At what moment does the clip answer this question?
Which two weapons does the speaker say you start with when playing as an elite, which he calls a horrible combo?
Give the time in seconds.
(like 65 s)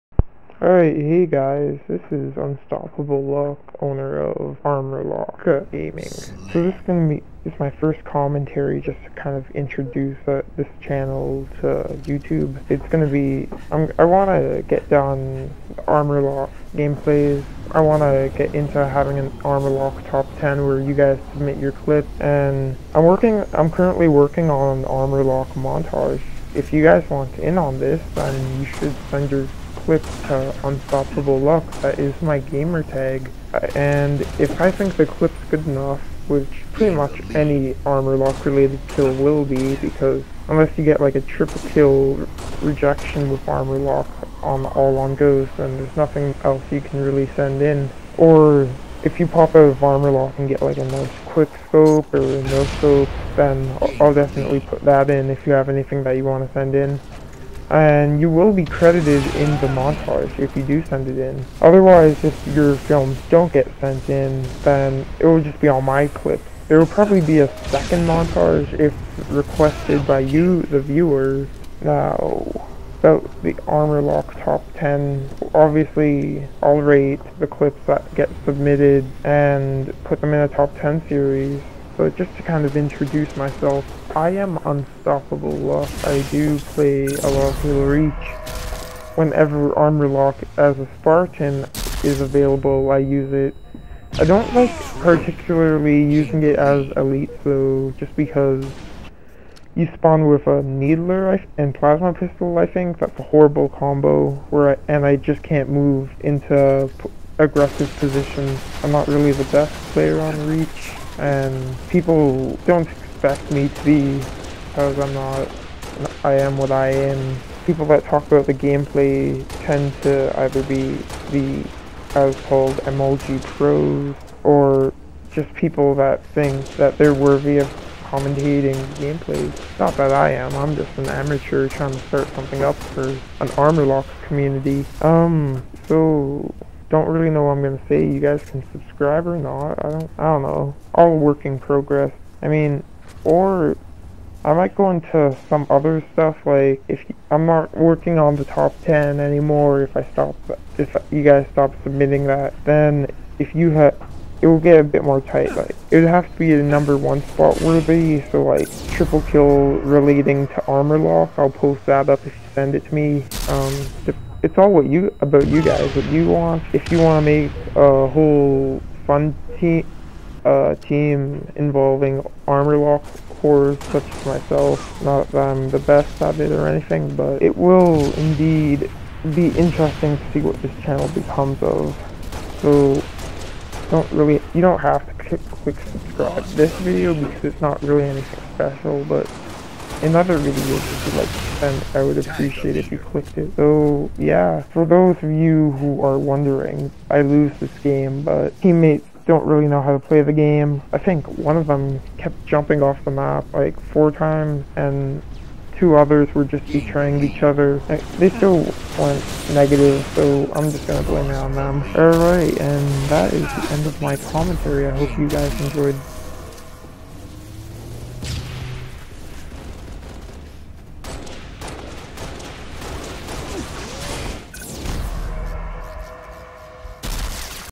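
100 s.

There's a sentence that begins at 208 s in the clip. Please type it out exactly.
They still went negative, so I'm just gonna blame it on them.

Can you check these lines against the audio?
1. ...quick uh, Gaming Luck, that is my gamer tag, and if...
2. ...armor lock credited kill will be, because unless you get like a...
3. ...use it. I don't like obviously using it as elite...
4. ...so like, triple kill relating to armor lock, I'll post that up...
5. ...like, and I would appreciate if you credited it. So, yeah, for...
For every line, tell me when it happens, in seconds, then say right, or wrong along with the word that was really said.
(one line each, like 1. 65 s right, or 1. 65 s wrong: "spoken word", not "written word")
1. 29 s wrong: "Unstoppable", not "Gaming"
2. 37 s wrong: "related", not "credited"
3. 92 s wrong: "particularly", not "obviously"
4. 158 s right
5. 191 s wrong: "clicked", not "credited".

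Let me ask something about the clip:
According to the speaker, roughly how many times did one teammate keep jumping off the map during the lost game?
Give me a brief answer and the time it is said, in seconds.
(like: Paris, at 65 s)
4, at 203 s.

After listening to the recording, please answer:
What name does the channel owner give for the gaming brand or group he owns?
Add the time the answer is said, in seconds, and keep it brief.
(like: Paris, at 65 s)
Armor Lock Gaming, at 4 s.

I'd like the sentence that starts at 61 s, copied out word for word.
Otherwise, if your films don't get sent in, then it will just be on my clips.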